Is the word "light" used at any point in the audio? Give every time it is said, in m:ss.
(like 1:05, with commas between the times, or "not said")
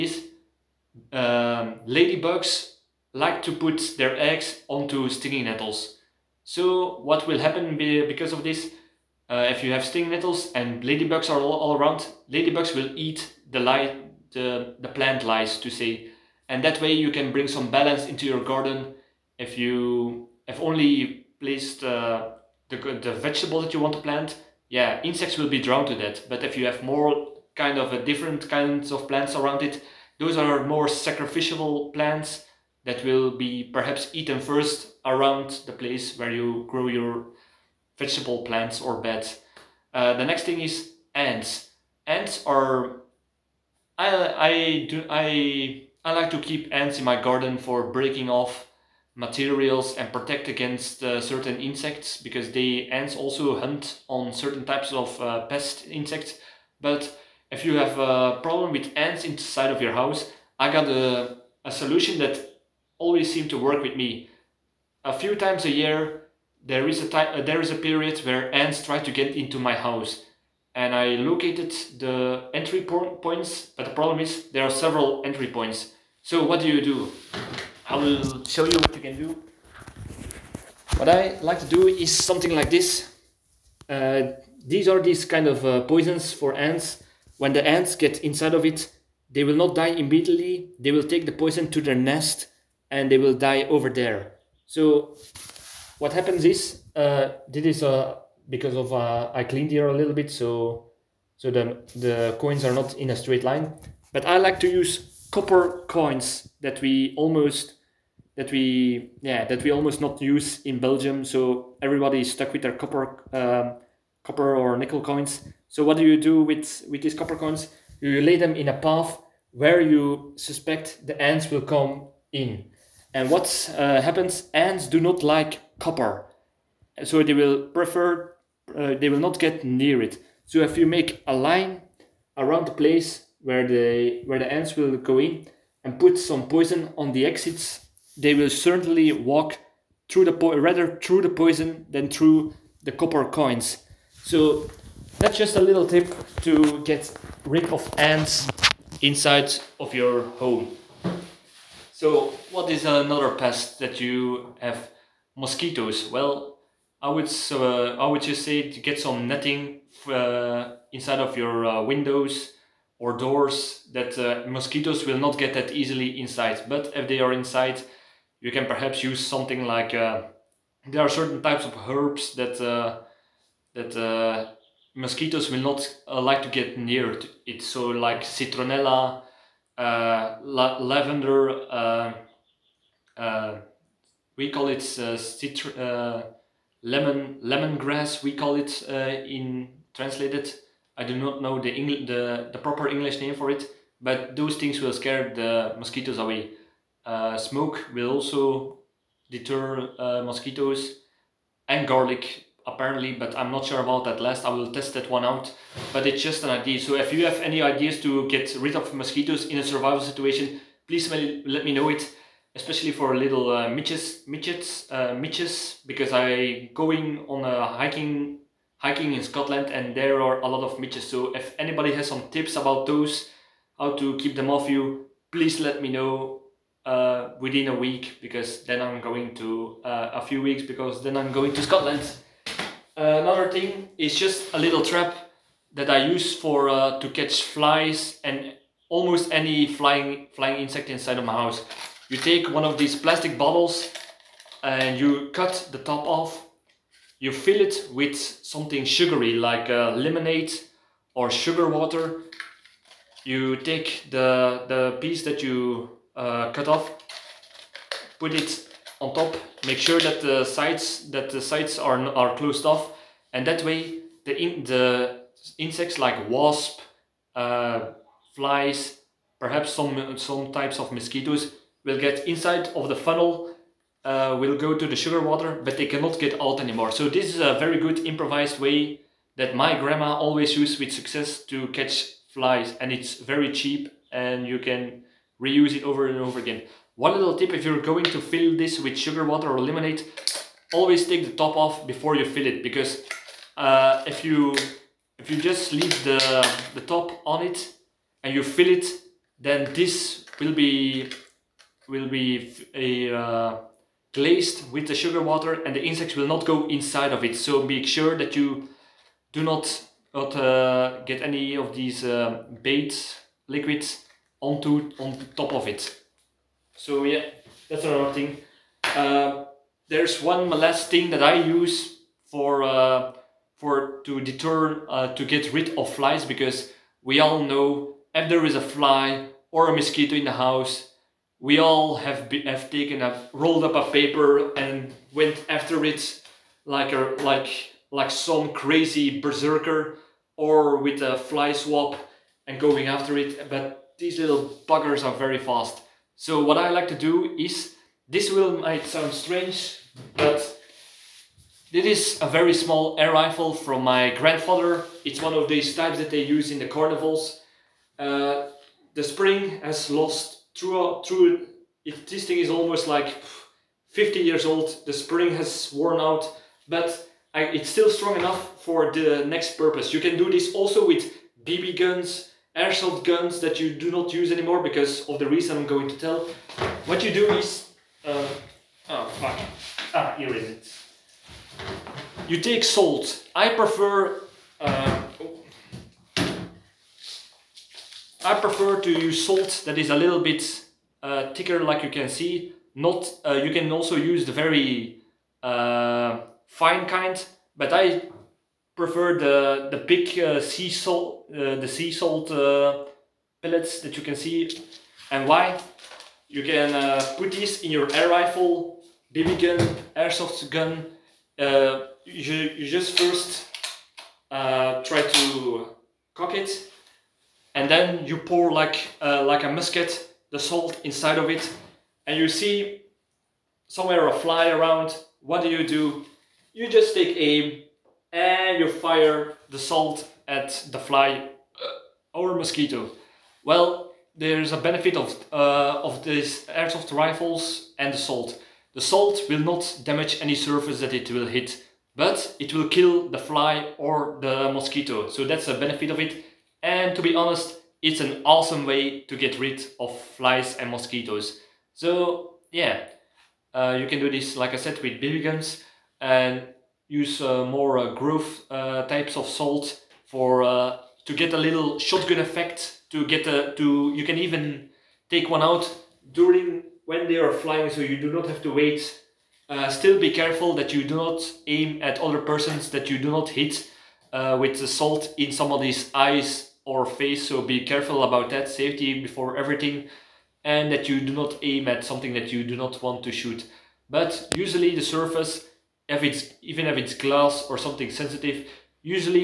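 0:13.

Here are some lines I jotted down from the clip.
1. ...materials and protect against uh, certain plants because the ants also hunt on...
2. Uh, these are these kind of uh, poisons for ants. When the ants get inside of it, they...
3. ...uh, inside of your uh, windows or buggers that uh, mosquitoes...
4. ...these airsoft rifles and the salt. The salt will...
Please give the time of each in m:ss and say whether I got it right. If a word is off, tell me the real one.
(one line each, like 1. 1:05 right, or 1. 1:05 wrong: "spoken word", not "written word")
1. 0:49 wrong: "insects", not "plants"
2. 1:23 right
3. 2:40 wrong: "doors", not "buggers"
4. 7:16 right.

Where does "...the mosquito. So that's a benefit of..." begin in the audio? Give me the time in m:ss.
7:24.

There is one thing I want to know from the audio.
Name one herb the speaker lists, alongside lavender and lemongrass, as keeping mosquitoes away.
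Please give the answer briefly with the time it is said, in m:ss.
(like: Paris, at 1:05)
citronella, at 2:58.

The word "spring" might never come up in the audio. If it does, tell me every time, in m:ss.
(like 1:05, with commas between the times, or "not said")
5:59, 6:04.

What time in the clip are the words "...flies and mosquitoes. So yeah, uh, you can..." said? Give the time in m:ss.
7:29.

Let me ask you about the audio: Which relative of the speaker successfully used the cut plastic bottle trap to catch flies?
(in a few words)
grandma.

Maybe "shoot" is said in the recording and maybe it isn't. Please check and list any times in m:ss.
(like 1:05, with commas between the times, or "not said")
8:03.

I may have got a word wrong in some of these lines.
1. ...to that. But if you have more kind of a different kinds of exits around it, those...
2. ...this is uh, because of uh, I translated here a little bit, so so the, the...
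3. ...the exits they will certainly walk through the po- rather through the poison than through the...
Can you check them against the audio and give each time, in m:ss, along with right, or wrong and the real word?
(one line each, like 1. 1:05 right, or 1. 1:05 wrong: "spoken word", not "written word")
1. 0:25 wrong: "plants", not "exits"
2. 1:37 wrong: "cleaned", not "translated"
3. 2:17 right.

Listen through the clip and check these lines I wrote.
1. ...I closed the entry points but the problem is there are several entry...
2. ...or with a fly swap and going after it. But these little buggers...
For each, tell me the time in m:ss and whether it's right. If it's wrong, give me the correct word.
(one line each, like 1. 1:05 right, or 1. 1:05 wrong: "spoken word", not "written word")
1. 1:10 wrong: "located", not "closed"
2. 5:40 right.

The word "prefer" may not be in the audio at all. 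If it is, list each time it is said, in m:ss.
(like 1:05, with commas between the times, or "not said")
2:07, 6:23, 6:28, 6:38.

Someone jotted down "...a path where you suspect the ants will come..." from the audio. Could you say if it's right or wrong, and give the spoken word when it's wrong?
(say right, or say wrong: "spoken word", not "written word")
right.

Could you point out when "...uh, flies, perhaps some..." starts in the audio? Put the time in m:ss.
4:27.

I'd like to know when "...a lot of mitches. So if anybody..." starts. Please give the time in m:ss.
3:40.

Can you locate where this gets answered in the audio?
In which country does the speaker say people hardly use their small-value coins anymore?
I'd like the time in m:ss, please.
1:50.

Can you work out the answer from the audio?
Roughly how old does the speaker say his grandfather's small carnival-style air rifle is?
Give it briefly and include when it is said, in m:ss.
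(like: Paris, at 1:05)
almost 50 years, at 6:02.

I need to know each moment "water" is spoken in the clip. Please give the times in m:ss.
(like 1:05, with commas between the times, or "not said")
4:11, 4:35, 4:49, 5:05.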